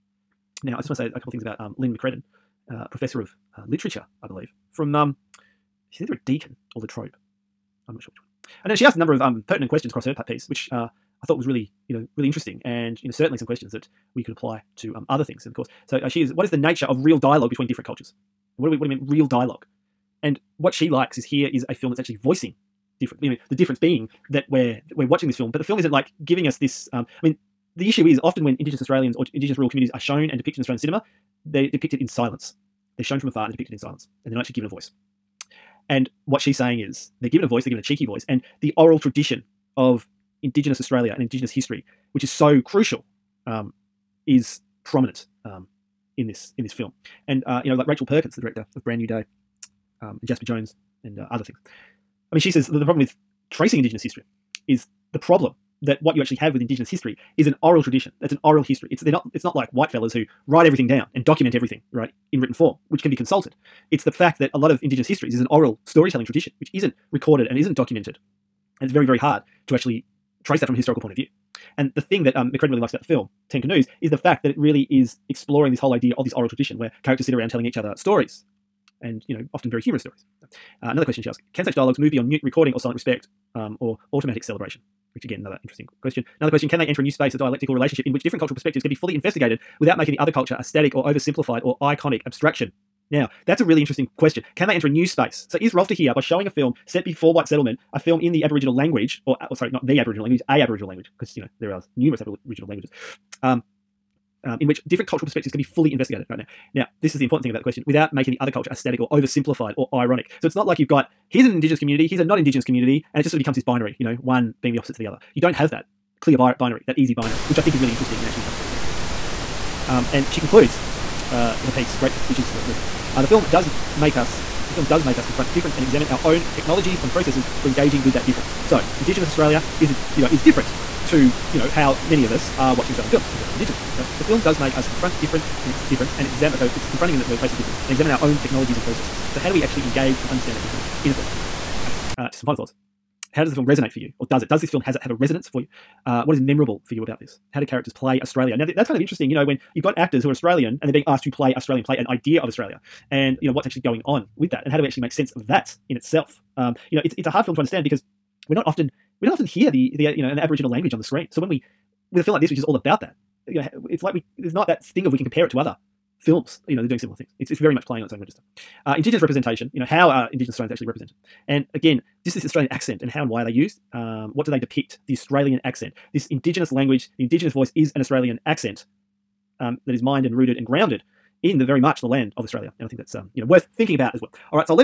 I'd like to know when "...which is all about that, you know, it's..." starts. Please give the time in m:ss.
2:42.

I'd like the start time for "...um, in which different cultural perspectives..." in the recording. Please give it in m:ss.
1:44.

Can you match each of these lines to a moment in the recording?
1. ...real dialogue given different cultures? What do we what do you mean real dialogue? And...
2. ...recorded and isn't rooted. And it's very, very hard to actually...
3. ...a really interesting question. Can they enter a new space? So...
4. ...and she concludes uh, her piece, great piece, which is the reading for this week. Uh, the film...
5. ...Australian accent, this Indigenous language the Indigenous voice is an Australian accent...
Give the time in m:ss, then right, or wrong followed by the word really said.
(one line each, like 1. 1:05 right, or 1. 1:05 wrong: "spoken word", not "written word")
1. 0:17 wrong: "between", not "given"
2. 1:07 wrong: "documented", not "rooted"
3. 1:33 right
4. 2:00 right
5. 2:55 right.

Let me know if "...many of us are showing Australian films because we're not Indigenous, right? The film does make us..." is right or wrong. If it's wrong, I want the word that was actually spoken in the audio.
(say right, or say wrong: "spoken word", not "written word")
wrong: "watching", not "showing".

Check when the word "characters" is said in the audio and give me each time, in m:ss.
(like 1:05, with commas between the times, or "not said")
1:17, 2:27.